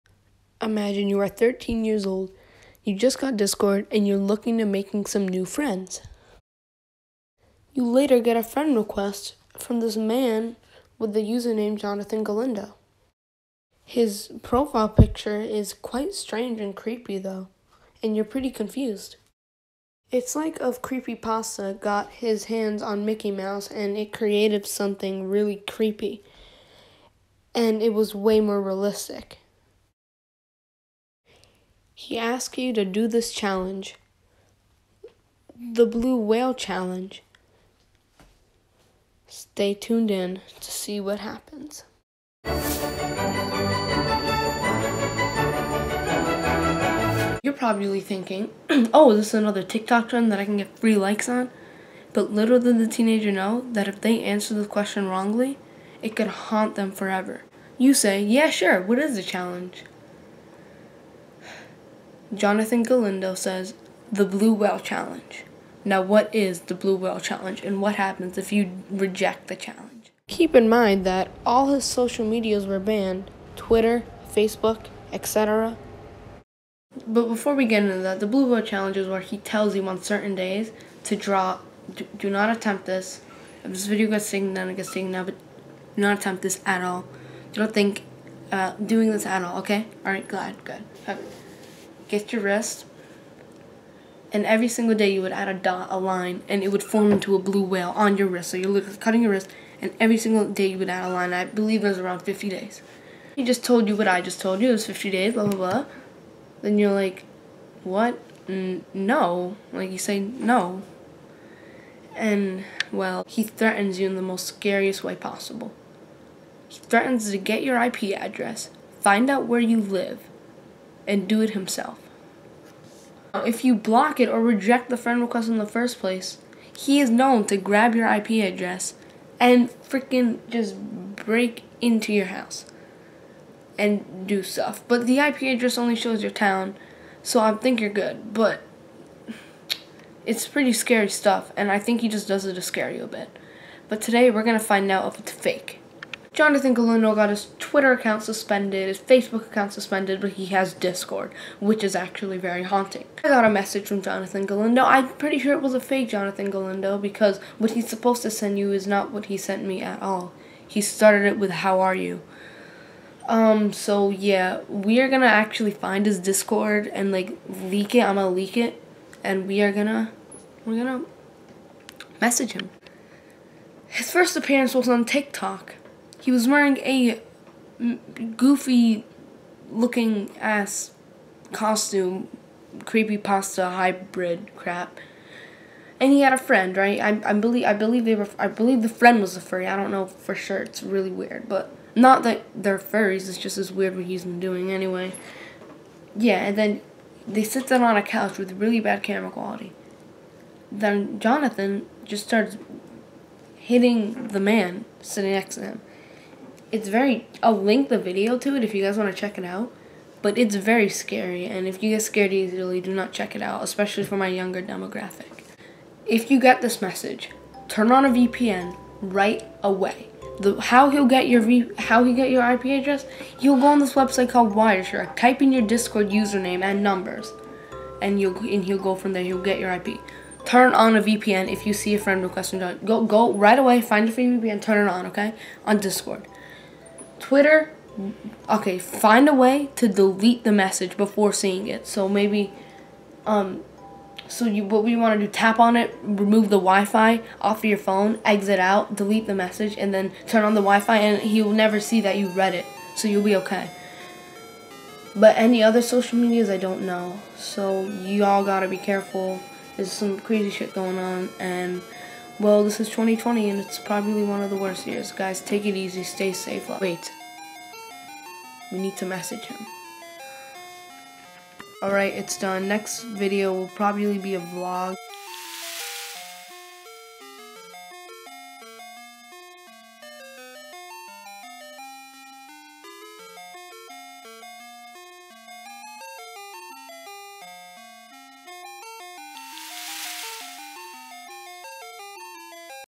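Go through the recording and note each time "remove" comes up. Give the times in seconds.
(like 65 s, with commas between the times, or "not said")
246 s.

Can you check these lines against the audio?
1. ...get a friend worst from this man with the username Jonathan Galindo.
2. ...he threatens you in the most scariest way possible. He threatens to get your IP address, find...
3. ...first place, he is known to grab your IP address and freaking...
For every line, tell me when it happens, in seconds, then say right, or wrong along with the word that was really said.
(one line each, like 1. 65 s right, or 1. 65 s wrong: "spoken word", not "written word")
1. 8 s wrong: "request", not "worst"
2. 113 s right
3. 125 s right.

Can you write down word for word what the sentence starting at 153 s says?
I got a message from Jonathan Galindo.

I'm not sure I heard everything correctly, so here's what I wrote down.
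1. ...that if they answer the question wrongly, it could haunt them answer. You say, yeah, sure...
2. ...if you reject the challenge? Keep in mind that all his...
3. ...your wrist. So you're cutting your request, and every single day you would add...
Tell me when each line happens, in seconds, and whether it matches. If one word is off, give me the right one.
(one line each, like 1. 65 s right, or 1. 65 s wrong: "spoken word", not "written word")
1. 53 s wrong: "forever", not "answer"
2. 68 s right
3. 98 s wrong: "wrist", not "request".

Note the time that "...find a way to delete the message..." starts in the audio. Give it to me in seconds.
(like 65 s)
238 s.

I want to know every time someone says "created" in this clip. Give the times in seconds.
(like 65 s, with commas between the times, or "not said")
24 s.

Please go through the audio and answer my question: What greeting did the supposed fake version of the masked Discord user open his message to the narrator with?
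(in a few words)
How are you?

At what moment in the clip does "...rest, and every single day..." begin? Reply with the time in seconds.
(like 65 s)
92 s.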